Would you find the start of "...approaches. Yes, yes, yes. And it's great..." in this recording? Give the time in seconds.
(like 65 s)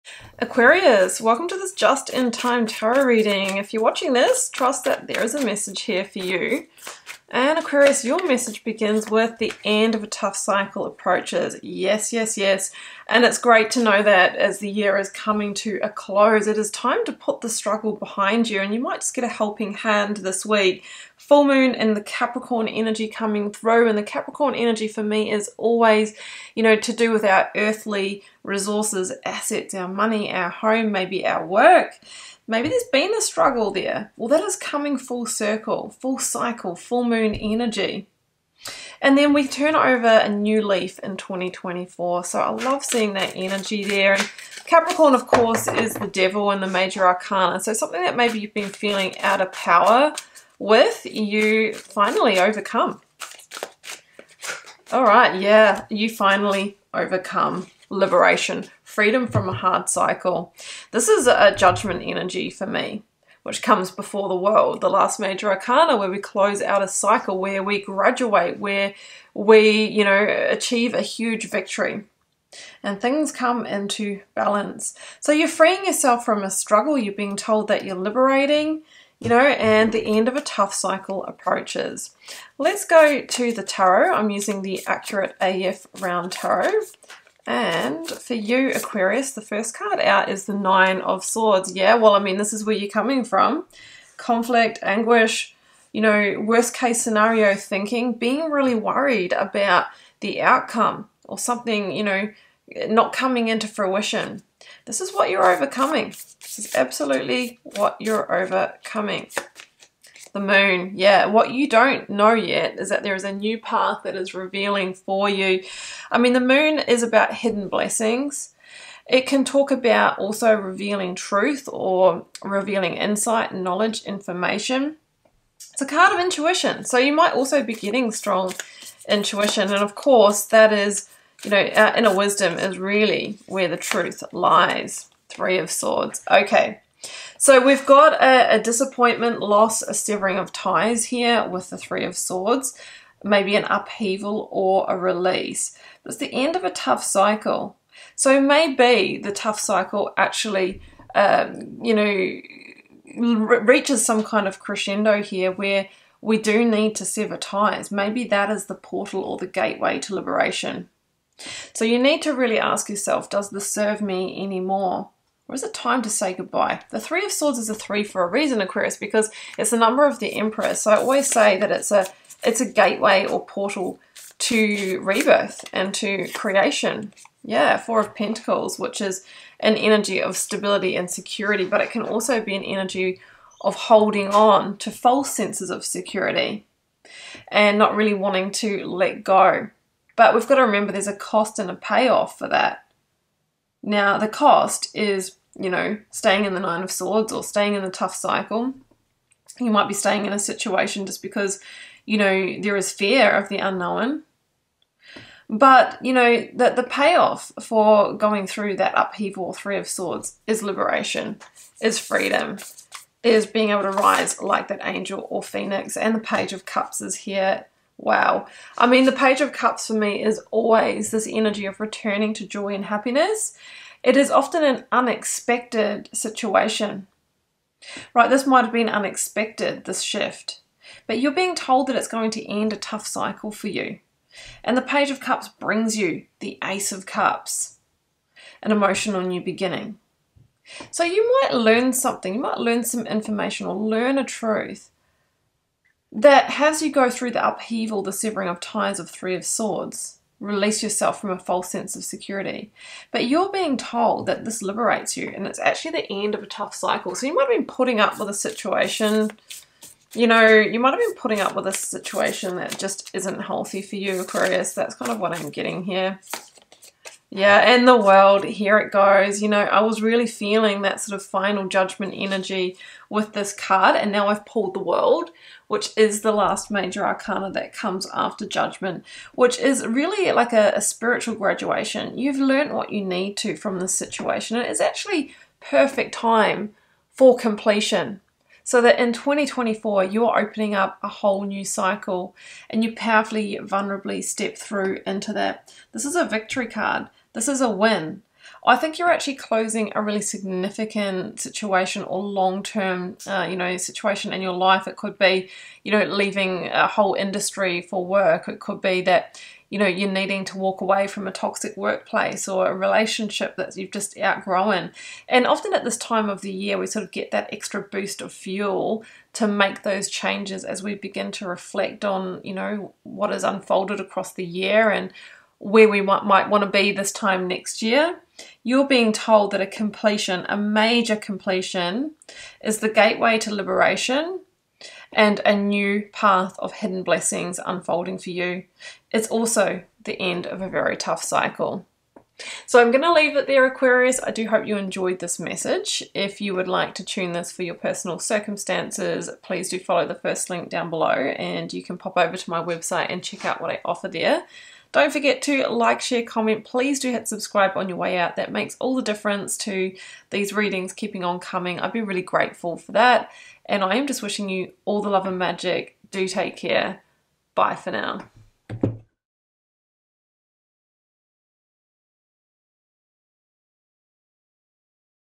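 10 s.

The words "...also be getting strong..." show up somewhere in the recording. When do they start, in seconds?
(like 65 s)
127 s.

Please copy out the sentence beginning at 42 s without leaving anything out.
So I love seeing that energy there.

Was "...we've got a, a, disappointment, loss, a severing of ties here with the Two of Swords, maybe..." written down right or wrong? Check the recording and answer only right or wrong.
wrong.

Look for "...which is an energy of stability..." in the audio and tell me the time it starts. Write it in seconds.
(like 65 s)
178 s.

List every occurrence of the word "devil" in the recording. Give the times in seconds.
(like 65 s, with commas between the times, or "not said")
46 s.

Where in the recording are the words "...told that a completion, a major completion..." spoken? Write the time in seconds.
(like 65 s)
329 s.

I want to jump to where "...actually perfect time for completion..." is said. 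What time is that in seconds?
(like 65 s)
284 s.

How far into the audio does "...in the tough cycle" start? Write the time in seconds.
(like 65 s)
197 s.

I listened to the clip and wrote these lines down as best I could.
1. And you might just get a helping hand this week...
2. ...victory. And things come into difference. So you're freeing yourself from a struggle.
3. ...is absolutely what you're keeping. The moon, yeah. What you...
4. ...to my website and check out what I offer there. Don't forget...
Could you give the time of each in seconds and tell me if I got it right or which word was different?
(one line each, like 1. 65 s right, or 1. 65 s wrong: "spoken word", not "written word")
1. 18 s right
2. 71 s wrong: "balance", not "difference"
3. 106 s wrong: "overcoming", not "keeping"
4. 352 s right.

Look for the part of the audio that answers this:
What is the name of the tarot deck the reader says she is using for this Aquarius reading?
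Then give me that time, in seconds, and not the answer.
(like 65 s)
84 s.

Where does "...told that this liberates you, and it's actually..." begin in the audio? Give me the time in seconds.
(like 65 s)
253 s.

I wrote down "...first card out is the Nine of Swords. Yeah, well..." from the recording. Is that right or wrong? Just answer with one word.
right.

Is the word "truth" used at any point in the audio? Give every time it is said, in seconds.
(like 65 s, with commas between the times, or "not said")
121 s, 133 s, 244 s.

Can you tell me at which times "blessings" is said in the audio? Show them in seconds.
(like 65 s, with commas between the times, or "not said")
117 s, 337 s.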